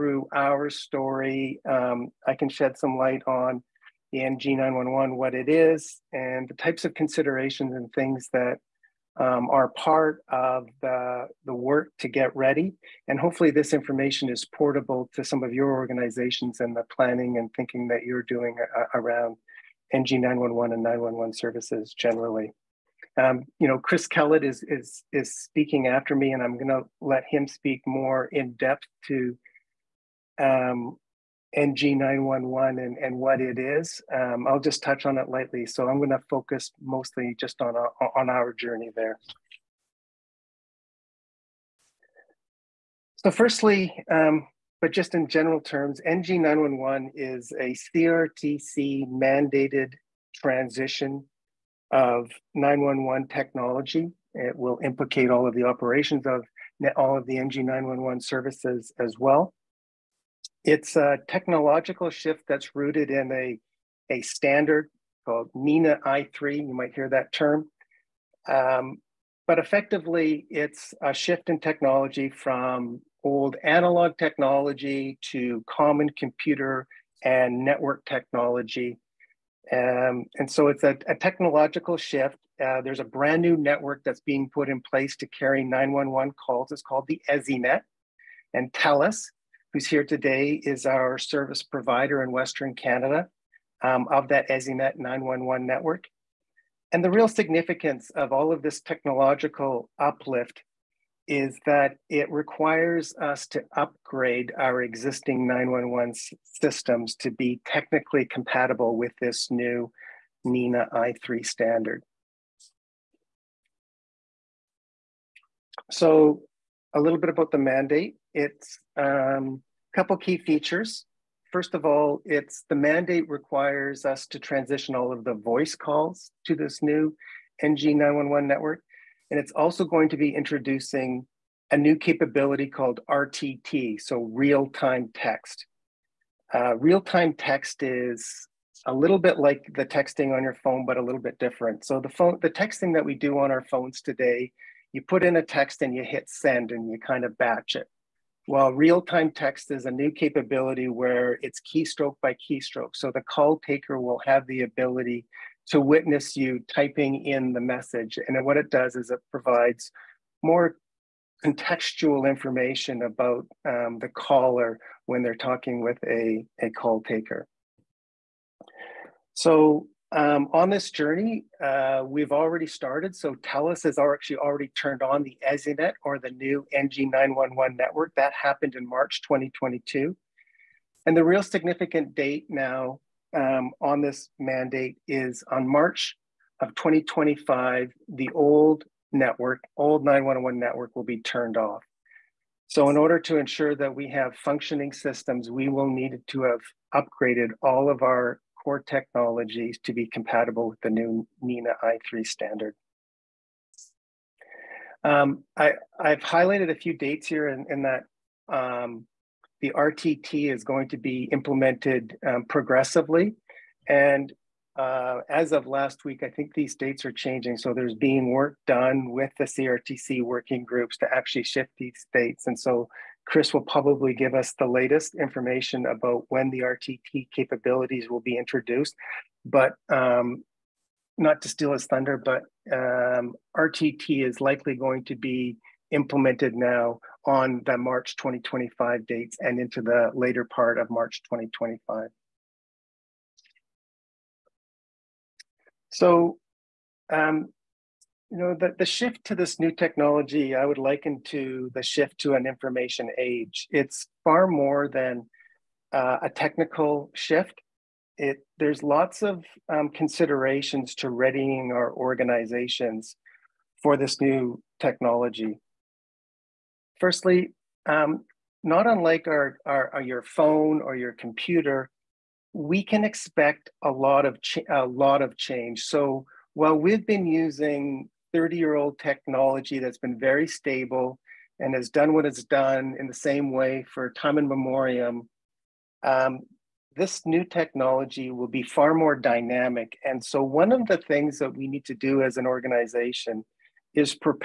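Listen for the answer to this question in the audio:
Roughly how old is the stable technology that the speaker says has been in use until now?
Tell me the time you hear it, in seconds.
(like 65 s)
278 s.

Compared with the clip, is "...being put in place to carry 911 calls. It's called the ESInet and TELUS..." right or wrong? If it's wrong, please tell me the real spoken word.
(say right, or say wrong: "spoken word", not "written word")
right.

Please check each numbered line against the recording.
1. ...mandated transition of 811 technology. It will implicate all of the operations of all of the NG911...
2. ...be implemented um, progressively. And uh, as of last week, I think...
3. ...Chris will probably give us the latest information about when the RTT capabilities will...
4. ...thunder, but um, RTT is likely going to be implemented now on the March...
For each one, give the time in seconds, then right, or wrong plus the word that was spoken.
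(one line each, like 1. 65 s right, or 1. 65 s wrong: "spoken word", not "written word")
1. 49 s wrong: "911", not "811"
2. 210 s right
3. 223 s right
4. 231 s right.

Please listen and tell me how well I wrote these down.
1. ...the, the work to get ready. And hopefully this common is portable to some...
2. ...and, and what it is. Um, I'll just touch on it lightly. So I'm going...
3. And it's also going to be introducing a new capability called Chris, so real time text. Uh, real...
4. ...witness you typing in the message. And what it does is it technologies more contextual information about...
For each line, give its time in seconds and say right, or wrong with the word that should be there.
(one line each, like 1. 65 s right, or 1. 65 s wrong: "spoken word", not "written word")
1. 10 s wrong: "information", not "common"
2. 32 s right
3. 129 s wrong: "RTT", not "Chris"
4. 155 s wrong: "provides", not "technologies".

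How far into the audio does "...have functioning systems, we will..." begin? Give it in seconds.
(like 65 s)
194 s.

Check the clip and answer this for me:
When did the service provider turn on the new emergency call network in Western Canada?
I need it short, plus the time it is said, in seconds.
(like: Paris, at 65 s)
March 2022, at 178 s.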